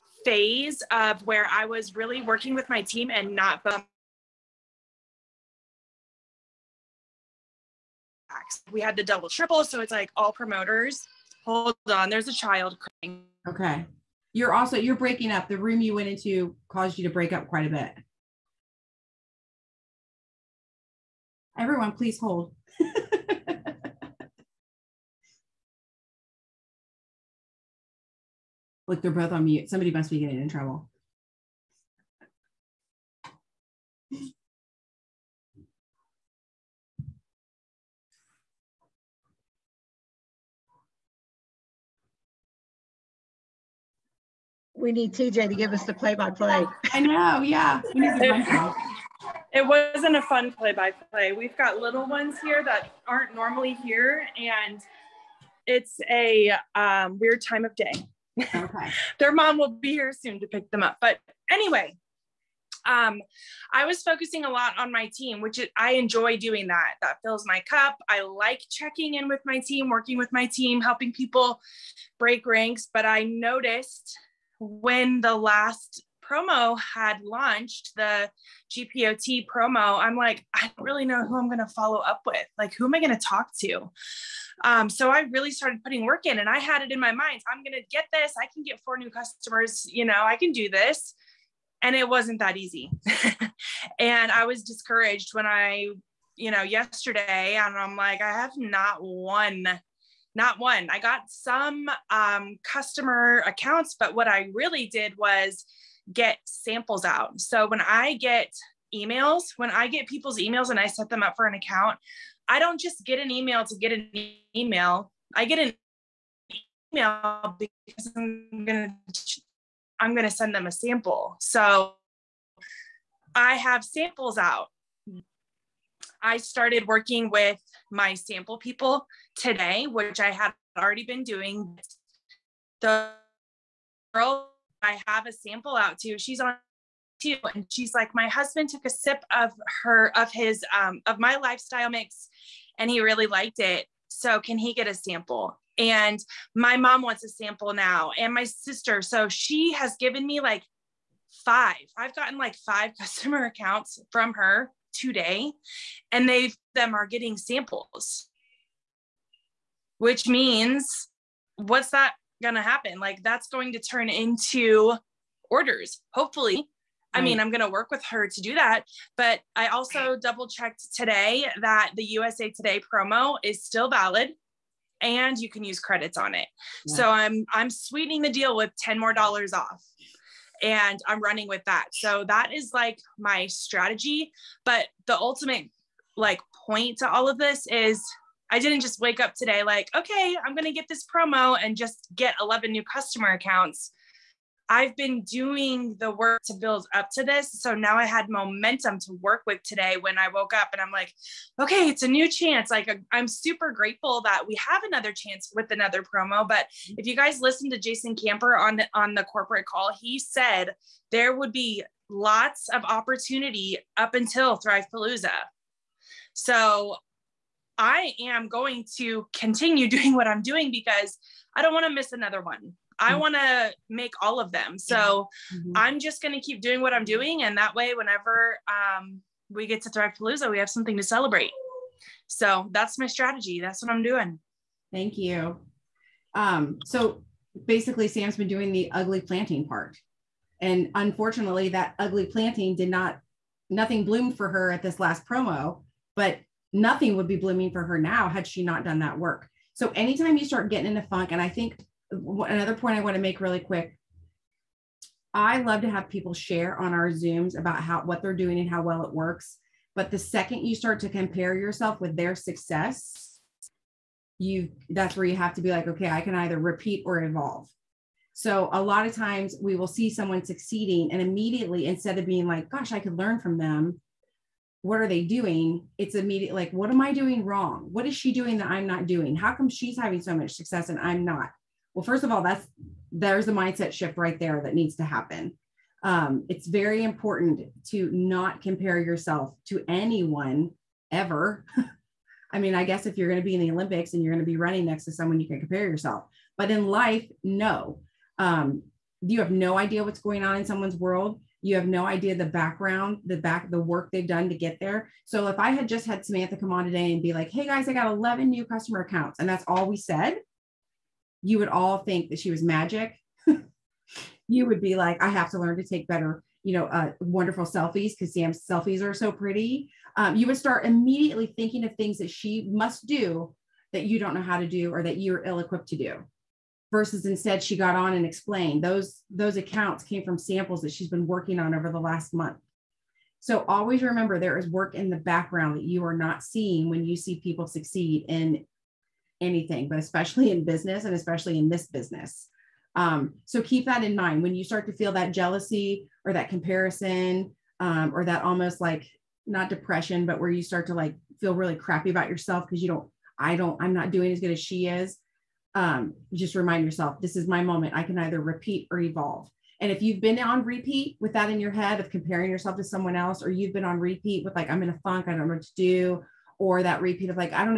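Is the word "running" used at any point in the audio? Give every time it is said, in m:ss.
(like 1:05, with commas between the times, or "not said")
3:01, 4:54.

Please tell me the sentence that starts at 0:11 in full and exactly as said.
Hold on, there's a child crying.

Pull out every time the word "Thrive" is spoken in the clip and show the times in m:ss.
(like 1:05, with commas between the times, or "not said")
3:34, 3:49.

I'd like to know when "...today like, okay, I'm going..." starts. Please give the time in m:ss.
3:09.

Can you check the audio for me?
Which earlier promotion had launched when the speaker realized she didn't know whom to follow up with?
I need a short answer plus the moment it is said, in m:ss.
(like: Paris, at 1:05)
GPOT promo, at 1:18.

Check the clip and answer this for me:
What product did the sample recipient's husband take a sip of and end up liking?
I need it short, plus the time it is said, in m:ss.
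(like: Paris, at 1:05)
lifestyle mix, at 2:21.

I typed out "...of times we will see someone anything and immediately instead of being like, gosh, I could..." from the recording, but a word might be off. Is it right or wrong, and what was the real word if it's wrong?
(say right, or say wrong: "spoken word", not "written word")
wrong: "succeeding", not "anything".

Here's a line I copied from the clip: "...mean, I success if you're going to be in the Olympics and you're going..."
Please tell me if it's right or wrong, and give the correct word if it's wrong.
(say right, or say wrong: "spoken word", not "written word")
wrong: "guess", not "success".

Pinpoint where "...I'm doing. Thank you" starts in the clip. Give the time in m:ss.
3:53.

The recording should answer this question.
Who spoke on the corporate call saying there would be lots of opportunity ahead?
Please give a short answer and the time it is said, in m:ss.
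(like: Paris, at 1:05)
Jason Camper, at 3:27.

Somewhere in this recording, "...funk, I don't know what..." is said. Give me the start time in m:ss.
6:05.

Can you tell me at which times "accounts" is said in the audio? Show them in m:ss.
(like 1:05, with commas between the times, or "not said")
1:43, 1:51, 2:33, 3:13, 5:09, 5:29.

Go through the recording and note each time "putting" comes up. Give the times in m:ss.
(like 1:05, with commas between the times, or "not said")
1:25.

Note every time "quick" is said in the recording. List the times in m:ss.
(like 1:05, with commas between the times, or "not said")
4:13.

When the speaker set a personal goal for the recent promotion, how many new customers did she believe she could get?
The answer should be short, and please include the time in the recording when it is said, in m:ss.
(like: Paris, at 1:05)
4, at 1:28.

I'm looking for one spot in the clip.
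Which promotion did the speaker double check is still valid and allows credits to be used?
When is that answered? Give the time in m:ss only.
2:52.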